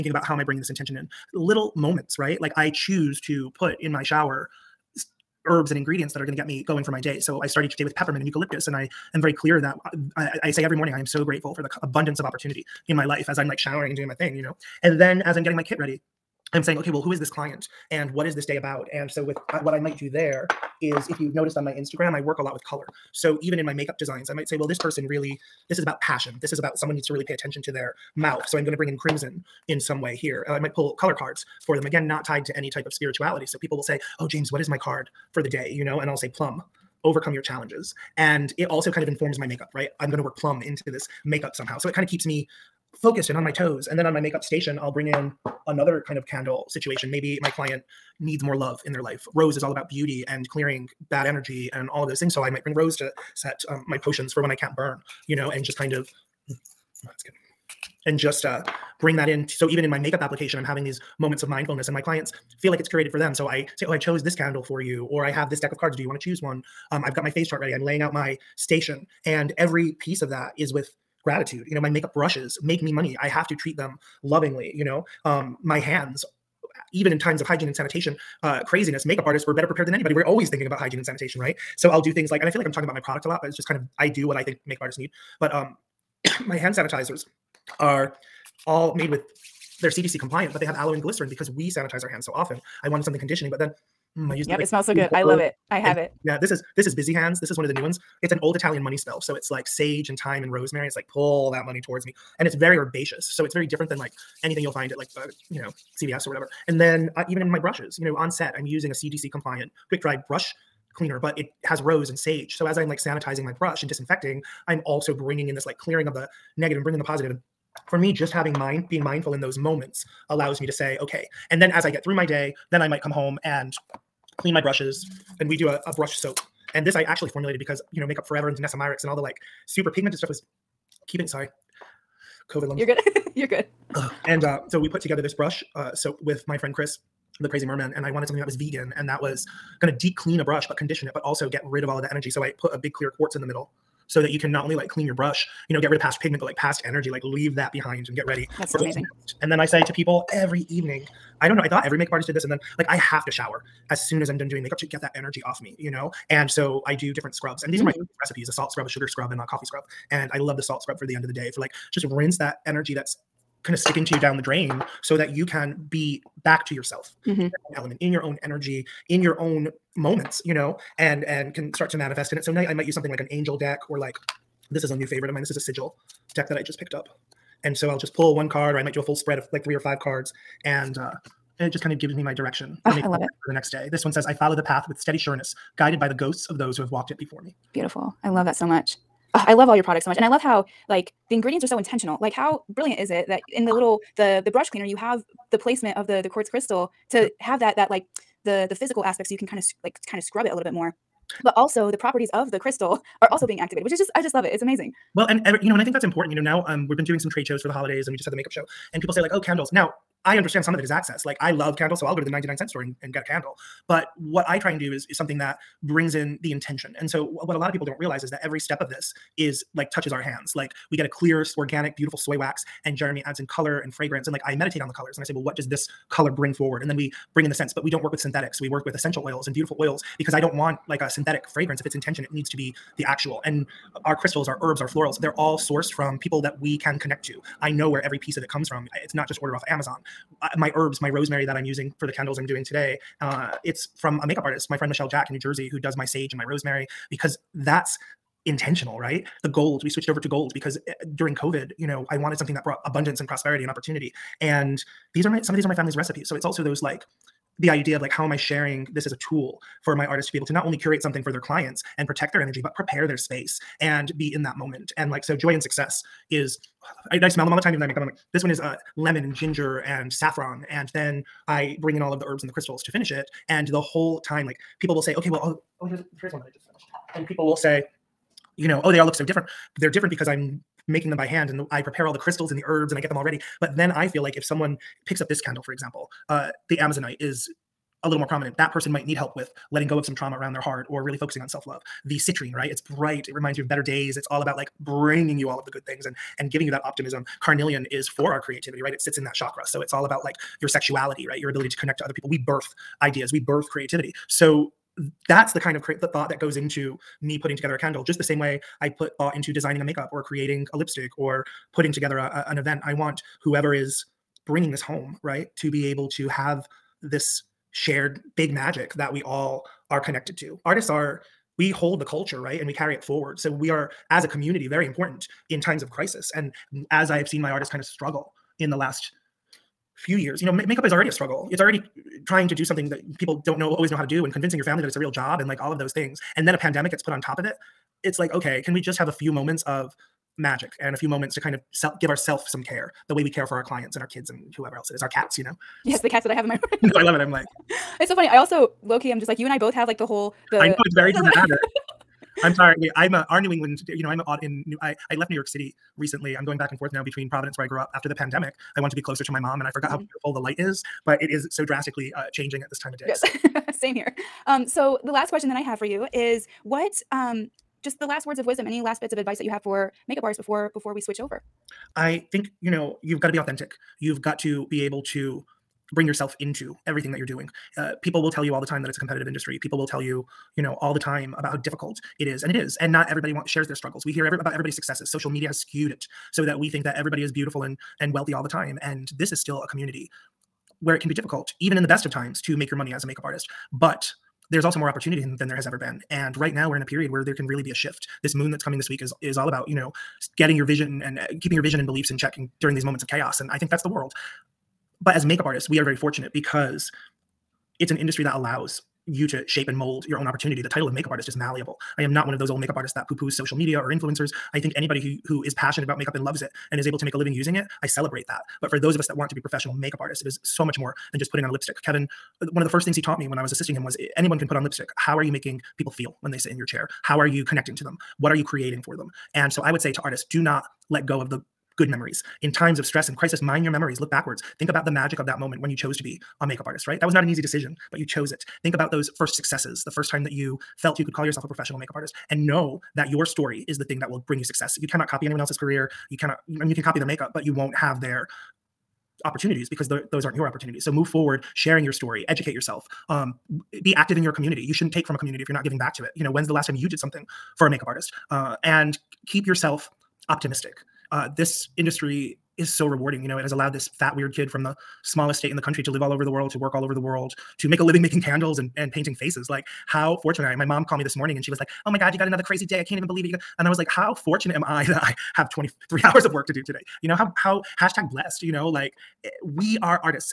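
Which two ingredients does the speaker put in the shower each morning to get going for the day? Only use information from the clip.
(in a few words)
peppermint and eucalyptus.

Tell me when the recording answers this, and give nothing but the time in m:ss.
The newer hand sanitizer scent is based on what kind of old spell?
1:38.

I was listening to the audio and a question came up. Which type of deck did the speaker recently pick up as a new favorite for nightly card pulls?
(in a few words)
sigil deck.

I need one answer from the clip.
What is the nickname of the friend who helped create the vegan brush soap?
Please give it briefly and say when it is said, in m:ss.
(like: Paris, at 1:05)
the crazy merman, at 2:17.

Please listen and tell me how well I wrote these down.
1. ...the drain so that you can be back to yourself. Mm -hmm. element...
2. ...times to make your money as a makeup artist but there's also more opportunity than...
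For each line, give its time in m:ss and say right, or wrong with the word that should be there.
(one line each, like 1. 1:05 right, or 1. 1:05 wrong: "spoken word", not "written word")
1. 2:44 right
2. 6:32 right.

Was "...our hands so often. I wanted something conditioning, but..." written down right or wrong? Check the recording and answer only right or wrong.
right.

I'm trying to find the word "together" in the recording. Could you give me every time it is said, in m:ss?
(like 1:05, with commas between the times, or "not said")
2:15, 5:07, 5:11.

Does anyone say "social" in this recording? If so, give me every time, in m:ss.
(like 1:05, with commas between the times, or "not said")
6:25, 6:53.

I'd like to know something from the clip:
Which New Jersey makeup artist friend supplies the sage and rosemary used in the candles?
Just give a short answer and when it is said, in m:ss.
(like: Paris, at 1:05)
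Michelle Jack, at 4:04.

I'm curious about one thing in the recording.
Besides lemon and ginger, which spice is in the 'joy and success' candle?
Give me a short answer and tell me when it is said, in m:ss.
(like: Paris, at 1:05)
saffron, at 4:30.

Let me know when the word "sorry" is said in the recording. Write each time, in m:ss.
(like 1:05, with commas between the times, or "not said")
2:11, 5:52.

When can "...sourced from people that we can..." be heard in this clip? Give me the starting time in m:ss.
3:55.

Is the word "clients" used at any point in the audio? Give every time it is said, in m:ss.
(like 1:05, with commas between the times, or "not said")
0:17, 0:47, 1:01, 4:21, 5:43.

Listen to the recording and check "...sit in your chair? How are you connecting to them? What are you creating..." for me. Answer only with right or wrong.
right.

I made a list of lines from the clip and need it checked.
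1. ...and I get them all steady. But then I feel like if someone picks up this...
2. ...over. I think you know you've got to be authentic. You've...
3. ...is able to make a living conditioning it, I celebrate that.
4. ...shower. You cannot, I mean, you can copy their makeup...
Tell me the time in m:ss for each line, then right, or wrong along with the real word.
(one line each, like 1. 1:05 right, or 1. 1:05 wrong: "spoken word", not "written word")
1. 4:42 wrong: "ready", not "steady"
2. 6:11 right
3. 6:56 wrong: "using", not "conditioning"
4. 7:25 wrong: "career", not "shower".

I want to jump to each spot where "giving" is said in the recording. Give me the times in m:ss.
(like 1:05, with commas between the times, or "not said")
4:56, 7:35.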